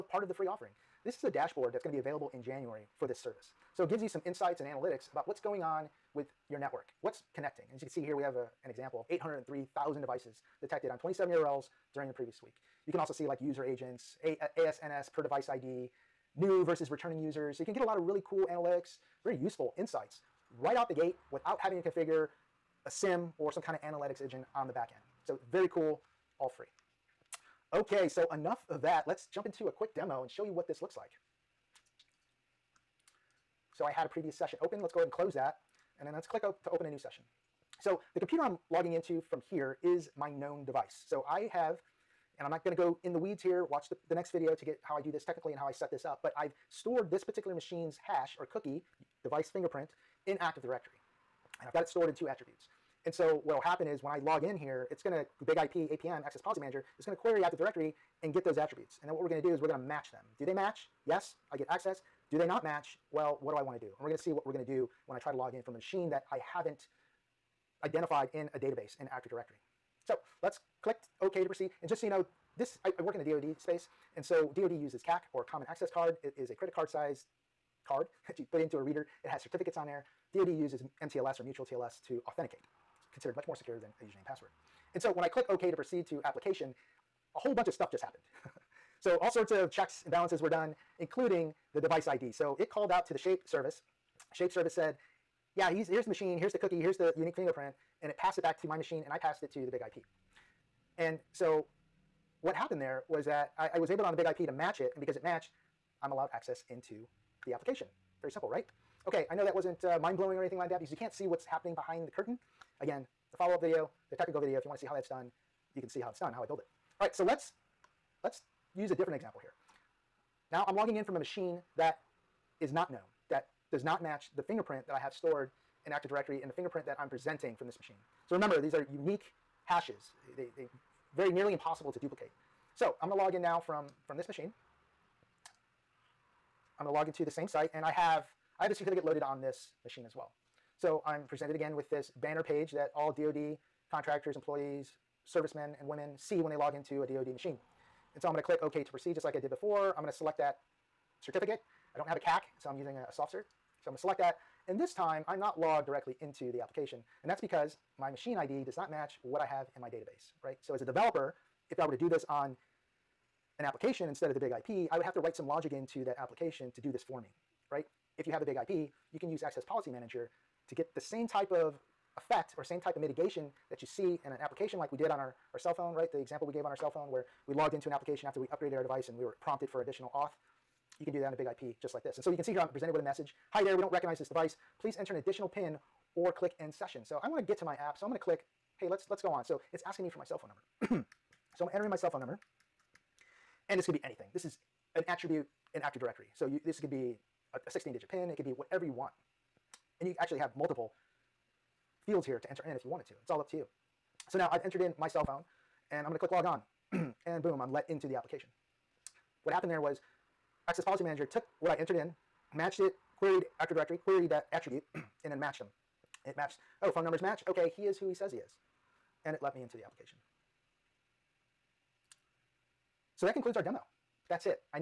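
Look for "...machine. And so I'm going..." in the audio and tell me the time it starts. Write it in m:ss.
2:27.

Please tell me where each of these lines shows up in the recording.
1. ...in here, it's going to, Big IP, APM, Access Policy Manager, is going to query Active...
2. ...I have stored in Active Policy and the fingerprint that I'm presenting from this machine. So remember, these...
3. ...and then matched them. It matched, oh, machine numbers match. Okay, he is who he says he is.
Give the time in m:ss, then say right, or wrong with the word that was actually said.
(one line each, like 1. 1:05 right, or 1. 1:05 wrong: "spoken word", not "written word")
1. 0:54 right
2. 2:04 wrong: "Directory", not "Policy"
3. 3:34 wrong: "phone", not "machine".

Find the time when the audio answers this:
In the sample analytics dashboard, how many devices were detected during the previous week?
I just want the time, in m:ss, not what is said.
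0:09.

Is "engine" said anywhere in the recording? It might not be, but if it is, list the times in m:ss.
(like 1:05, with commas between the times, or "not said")
0:24.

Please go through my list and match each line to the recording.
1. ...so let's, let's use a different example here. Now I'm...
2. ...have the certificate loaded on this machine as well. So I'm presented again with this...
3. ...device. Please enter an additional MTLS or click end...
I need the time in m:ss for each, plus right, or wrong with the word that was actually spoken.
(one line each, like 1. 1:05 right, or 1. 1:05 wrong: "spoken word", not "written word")
1. 1:57 right
2. 2:18 right
3. 3:04 wrong: "PIN", not "MTLS".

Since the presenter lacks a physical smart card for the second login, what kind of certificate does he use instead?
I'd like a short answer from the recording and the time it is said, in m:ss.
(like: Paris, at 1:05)
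soft cert, at 2:33.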